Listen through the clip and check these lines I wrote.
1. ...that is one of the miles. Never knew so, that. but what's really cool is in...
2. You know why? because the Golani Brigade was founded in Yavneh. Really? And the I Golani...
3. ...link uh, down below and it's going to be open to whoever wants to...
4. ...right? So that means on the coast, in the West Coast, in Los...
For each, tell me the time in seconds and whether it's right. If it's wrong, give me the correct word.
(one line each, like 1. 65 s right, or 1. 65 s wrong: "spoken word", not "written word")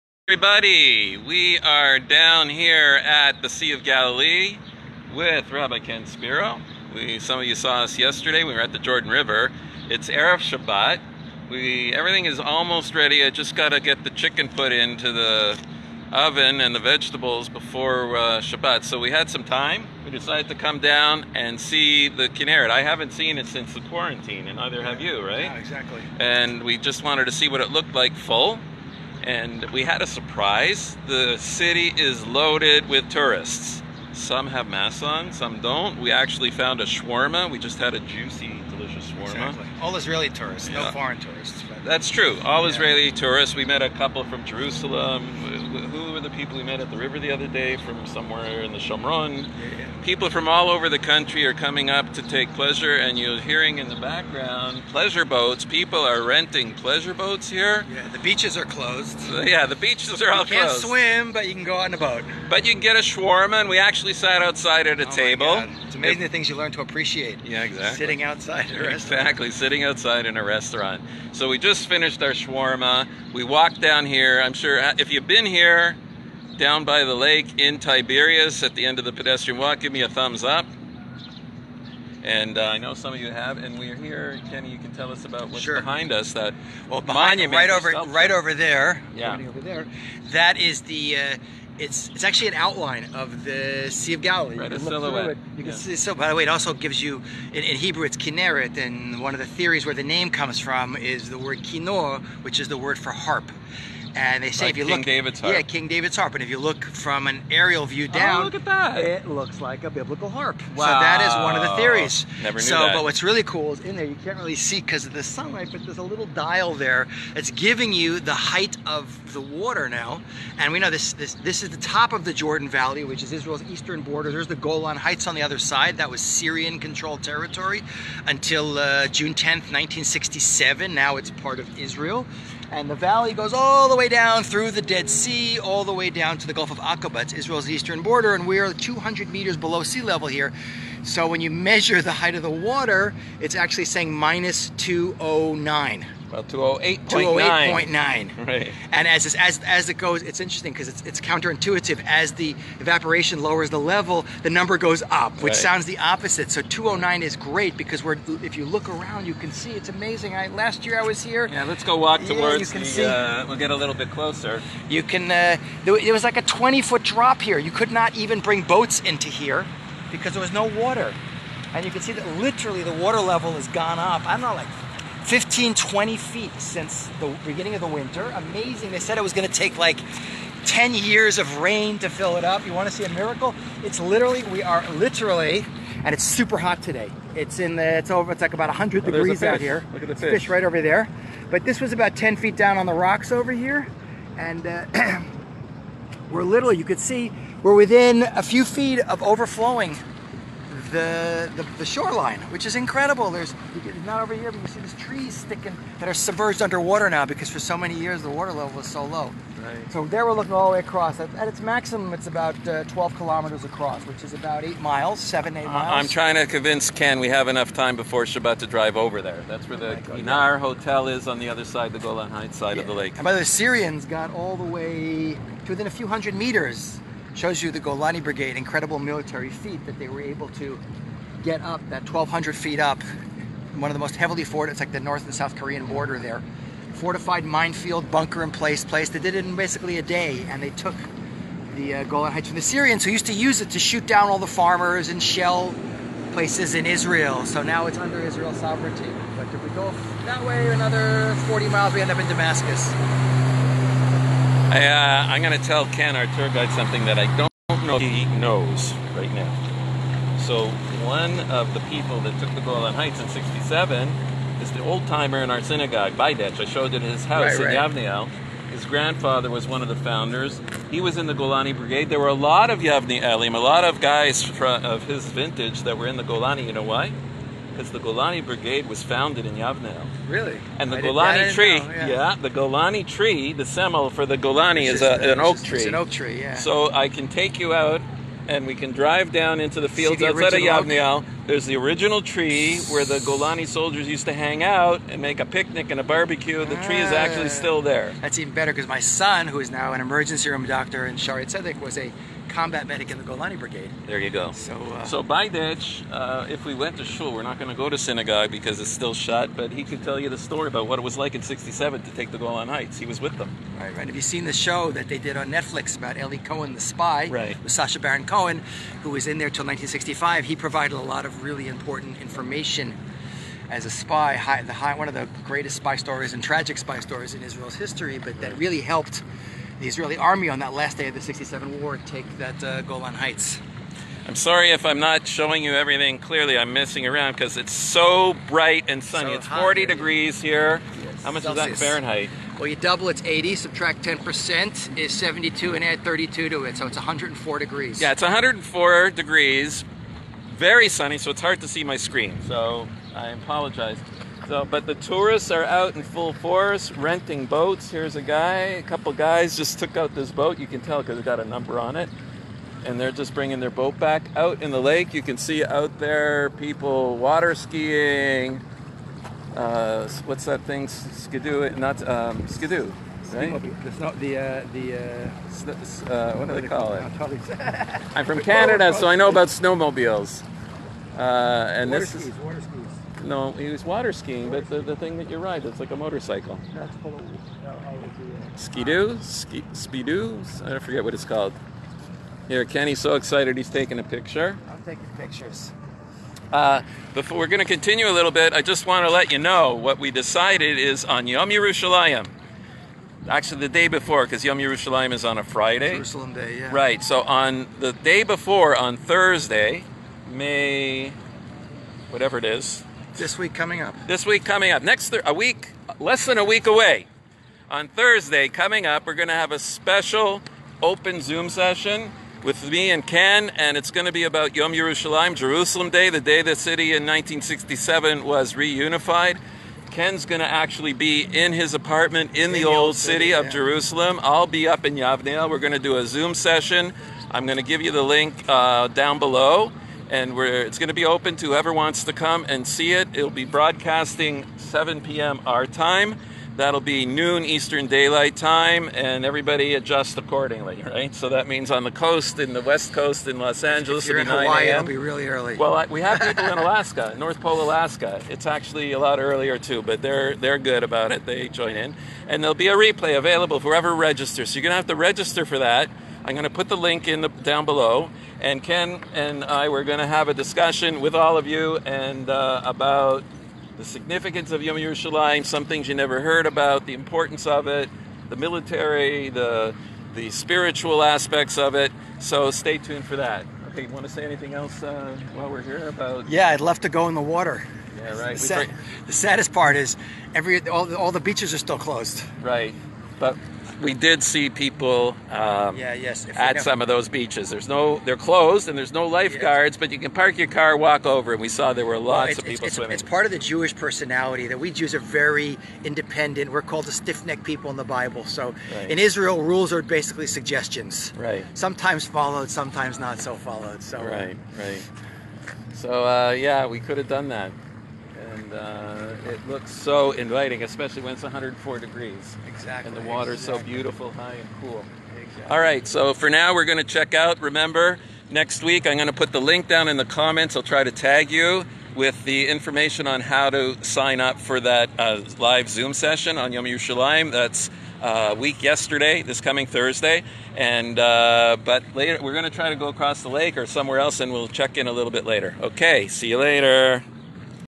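1. 110 s wrong: "theories", not "miles"
2. 276 s right
3. 438 s right
4. 450 s right.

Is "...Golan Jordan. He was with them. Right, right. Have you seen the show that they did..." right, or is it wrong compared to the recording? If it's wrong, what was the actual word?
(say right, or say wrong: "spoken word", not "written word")
wrong: "Heights", not "Jordan".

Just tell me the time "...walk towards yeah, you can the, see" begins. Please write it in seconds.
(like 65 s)
161 s.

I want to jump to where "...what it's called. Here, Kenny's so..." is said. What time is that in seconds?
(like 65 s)
391 s.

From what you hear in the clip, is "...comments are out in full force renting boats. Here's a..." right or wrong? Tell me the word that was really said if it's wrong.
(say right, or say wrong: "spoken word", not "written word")
wrong: "tourists", not "comments".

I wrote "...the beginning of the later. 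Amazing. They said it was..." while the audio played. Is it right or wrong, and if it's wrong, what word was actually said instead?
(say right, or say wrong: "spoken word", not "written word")
wrong: "winter", not "later".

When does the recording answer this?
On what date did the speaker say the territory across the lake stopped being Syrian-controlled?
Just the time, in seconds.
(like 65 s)
129 s.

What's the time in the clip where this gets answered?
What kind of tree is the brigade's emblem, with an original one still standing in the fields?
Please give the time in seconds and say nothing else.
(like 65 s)
285 s.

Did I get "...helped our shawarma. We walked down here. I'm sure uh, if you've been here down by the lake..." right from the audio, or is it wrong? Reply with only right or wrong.
wrong.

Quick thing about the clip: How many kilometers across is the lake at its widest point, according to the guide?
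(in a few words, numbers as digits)
12.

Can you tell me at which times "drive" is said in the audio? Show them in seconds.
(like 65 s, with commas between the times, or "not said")
218 s, 288 s.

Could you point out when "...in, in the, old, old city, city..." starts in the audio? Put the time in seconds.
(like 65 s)
432 s.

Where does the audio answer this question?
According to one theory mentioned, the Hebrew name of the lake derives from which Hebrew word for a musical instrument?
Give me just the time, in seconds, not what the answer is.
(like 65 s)
101 s.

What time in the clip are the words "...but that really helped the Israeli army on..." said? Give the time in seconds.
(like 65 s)
328 s.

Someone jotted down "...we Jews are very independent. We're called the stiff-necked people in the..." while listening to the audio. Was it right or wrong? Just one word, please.
right.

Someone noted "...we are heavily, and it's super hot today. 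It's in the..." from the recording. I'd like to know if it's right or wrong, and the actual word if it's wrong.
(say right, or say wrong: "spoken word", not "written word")
wrong: "literally", not "heavily".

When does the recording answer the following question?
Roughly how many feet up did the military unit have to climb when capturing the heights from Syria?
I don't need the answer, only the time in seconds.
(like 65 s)
232 s.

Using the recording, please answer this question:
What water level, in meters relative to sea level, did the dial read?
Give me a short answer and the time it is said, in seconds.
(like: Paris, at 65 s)
minus 209, at 144 s.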